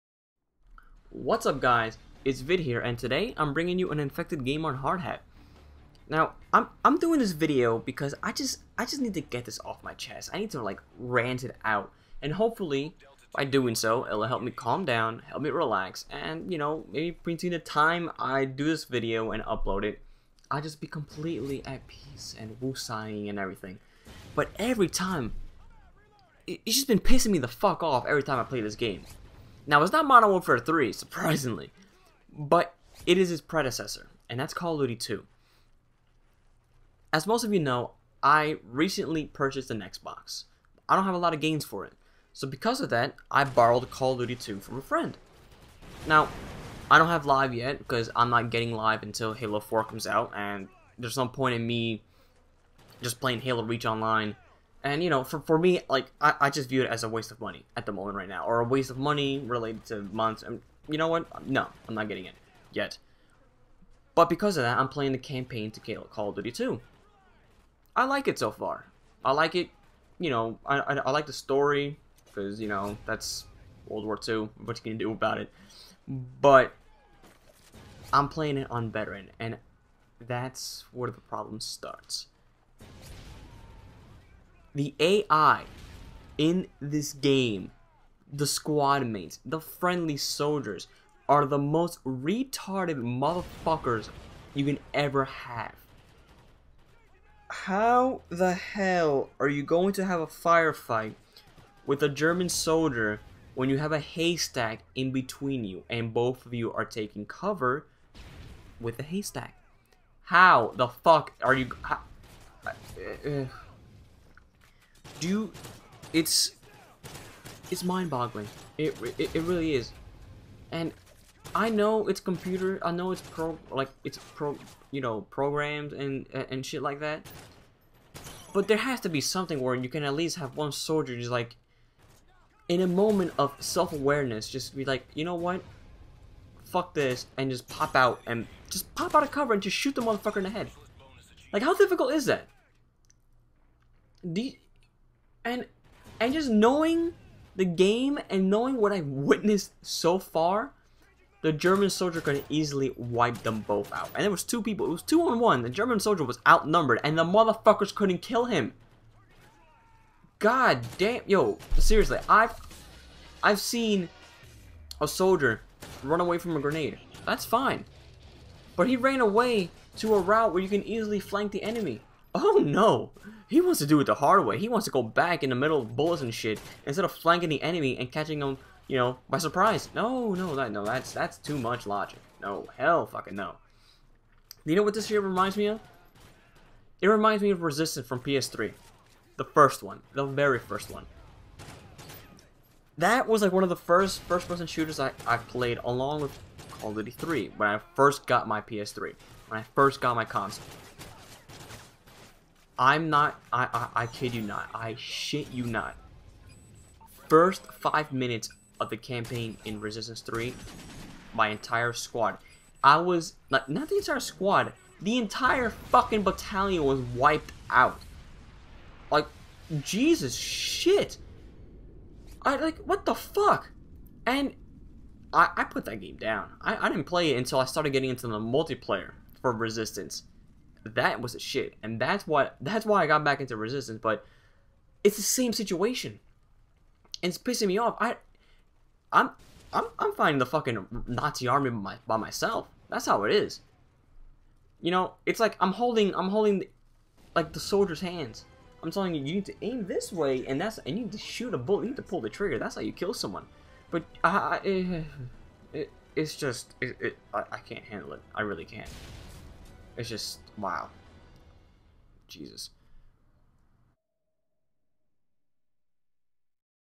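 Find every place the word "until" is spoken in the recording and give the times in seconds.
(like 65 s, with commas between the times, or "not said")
49 s, 227 s.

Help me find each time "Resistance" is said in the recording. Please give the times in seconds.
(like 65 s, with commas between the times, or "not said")
187 s, 209 s, 229 s, 233 s.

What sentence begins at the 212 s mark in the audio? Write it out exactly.
I was, not not the entire squad, the entire fucking battalion was wiped out.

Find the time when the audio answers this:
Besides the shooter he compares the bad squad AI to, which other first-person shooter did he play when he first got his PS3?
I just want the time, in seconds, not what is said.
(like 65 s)
196 s.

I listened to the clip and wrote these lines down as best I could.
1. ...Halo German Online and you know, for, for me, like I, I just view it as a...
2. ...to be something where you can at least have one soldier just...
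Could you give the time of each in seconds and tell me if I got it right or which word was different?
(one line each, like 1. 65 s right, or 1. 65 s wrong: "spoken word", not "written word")
1. 53 s wrong: "Reach", not "German"
2. 129 s right.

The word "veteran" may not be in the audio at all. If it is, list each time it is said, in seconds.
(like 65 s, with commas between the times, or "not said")
78 s.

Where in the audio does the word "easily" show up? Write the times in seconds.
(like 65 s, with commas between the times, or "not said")
152 s, 170 s.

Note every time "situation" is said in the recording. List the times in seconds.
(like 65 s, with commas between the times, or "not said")
235 s.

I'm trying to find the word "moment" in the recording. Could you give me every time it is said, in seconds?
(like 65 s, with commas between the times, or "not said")
57 s, 132 s.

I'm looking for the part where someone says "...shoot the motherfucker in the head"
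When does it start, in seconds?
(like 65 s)
139 s.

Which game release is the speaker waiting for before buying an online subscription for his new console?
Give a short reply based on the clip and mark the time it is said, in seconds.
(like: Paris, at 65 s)
Halo 4, at 49 s.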